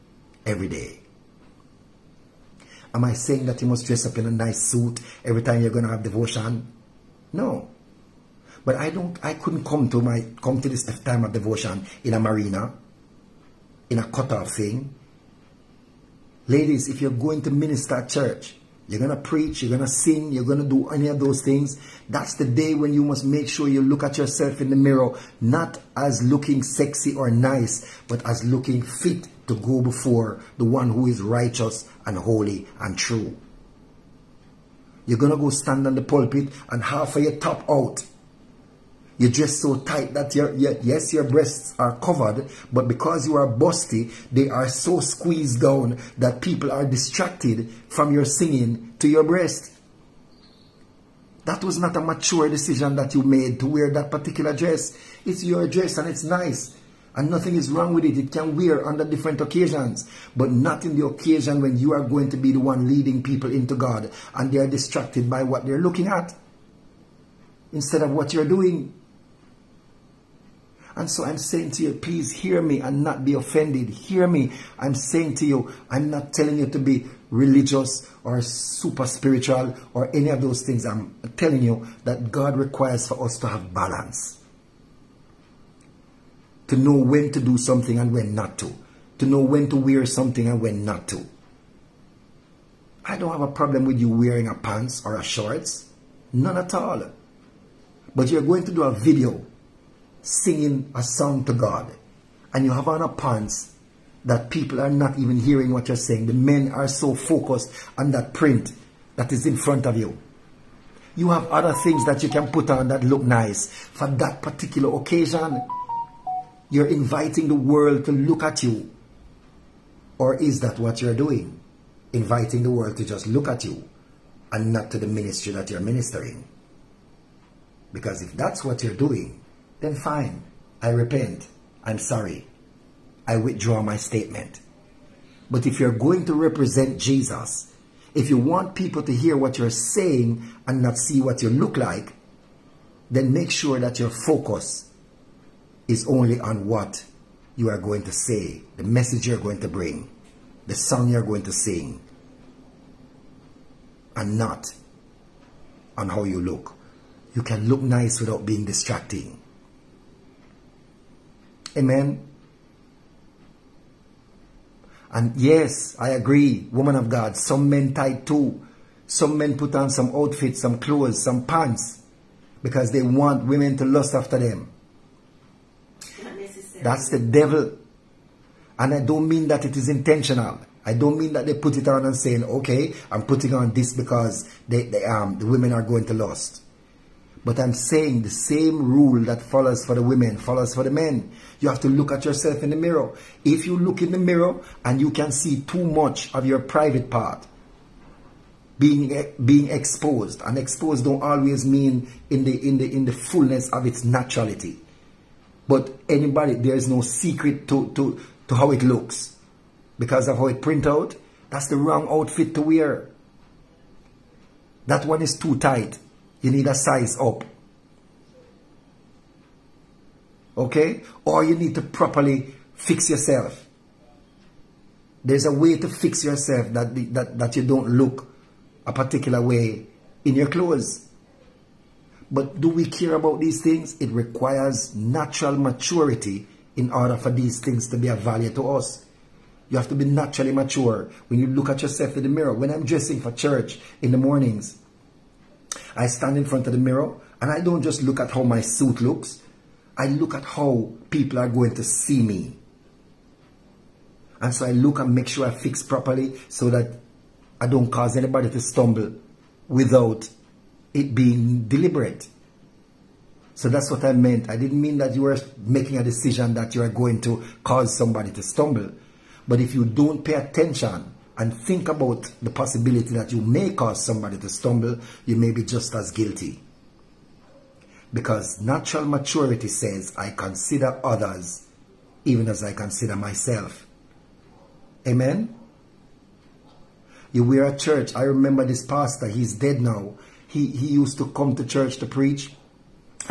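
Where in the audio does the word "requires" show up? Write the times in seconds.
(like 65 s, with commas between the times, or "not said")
82 s, 234 s.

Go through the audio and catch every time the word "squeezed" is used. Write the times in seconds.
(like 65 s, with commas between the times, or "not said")
45 s.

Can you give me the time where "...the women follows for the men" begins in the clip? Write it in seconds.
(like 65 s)
189 s.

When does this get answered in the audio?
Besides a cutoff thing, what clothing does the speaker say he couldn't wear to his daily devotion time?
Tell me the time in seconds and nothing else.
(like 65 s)
12 s.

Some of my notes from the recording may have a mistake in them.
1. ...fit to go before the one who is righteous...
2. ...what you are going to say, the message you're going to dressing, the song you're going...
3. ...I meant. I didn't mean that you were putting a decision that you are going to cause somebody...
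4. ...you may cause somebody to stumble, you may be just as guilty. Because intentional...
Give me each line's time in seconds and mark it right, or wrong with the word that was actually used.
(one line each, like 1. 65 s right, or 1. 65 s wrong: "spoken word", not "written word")
1. 28 s right
2. 146 s wrong: "bring", not "dressing"
3. 264 s wrong: "making", not "putting"
4. 273 s wrong: "natural", not "intentional".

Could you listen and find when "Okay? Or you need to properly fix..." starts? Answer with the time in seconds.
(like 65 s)
220 s.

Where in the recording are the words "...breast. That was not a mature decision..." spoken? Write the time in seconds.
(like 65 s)
49 s.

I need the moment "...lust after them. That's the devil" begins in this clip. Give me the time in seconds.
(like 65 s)
173 s.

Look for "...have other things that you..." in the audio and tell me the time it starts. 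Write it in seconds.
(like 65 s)
111 s.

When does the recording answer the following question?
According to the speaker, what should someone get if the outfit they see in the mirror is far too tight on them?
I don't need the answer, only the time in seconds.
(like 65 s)
216 s.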